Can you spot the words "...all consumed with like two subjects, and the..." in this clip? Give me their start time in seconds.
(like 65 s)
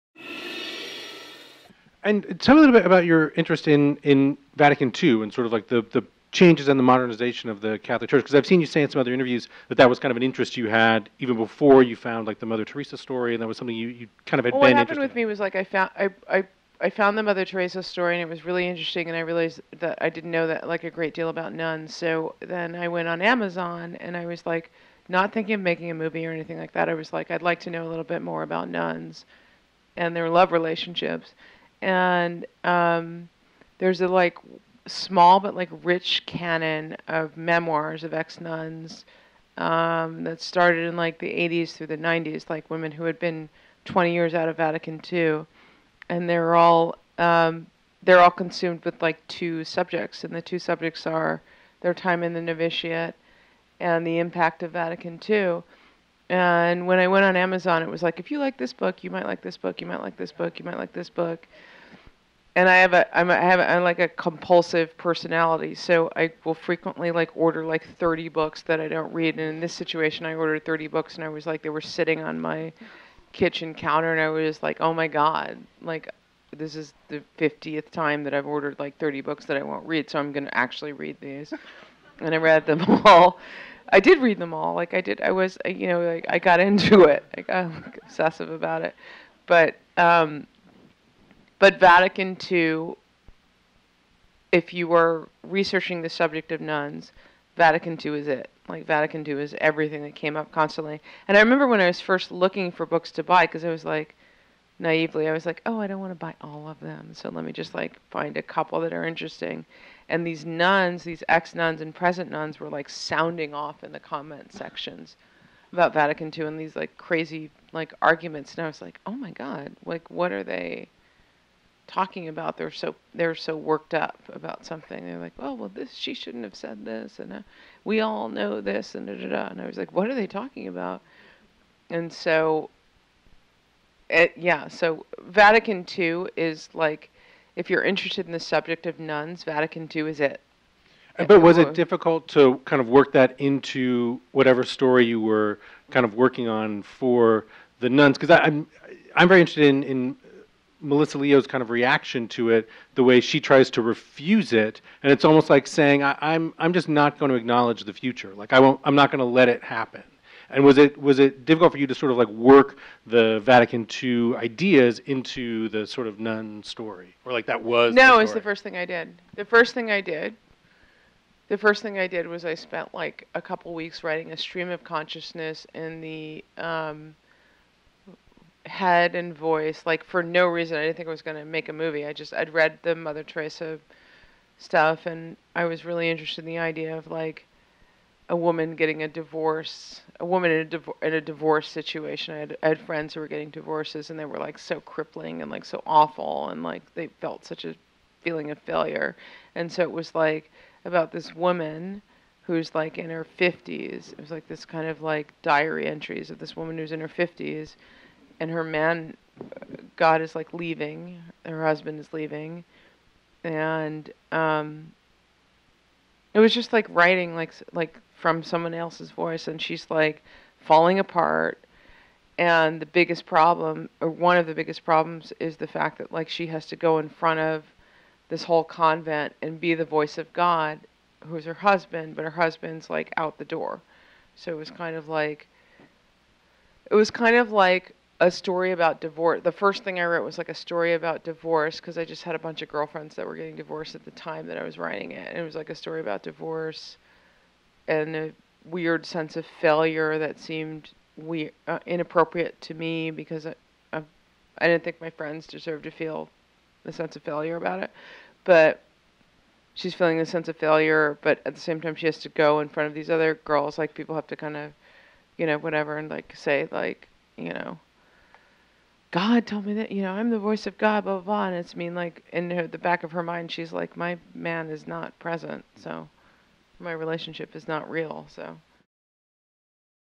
48 s.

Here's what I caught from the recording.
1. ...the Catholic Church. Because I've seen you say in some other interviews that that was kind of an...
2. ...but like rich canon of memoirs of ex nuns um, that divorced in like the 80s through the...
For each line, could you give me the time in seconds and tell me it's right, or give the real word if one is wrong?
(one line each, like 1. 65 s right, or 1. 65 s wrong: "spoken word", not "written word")
1. 7 s right
2. 35 s wrong: "started", not "divorced".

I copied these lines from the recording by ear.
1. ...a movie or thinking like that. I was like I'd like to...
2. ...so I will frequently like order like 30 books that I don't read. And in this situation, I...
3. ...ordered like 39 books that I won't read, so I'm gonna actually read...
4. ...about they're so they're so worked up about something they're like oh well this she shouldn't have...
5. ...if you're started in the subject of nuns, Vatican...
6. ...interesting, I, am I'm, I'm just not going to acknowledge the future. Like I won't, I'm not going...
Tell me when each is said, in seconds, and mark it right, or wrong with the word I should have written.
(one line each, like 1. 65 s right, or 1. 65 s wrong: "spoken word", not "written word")
1. 25 s wrong: "anything", not "thinking"
2. 65 s right
3. 78 s wrong: "30", not "39"
4. 122 s right
5. 137 s wrong: "interested", not "started"
6. 155 s wrong: "saying", not "interesting".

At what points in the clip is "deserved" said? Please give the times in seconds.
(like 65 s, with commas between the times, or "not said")
255 s.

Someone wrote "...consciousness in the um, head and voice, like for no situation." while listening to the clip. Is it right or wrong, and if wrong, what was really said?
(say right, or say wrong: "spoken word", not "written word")
wrong: "reason", not "situation".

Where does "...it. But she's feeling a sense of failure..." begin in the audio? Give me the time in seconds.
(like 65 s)
257 s.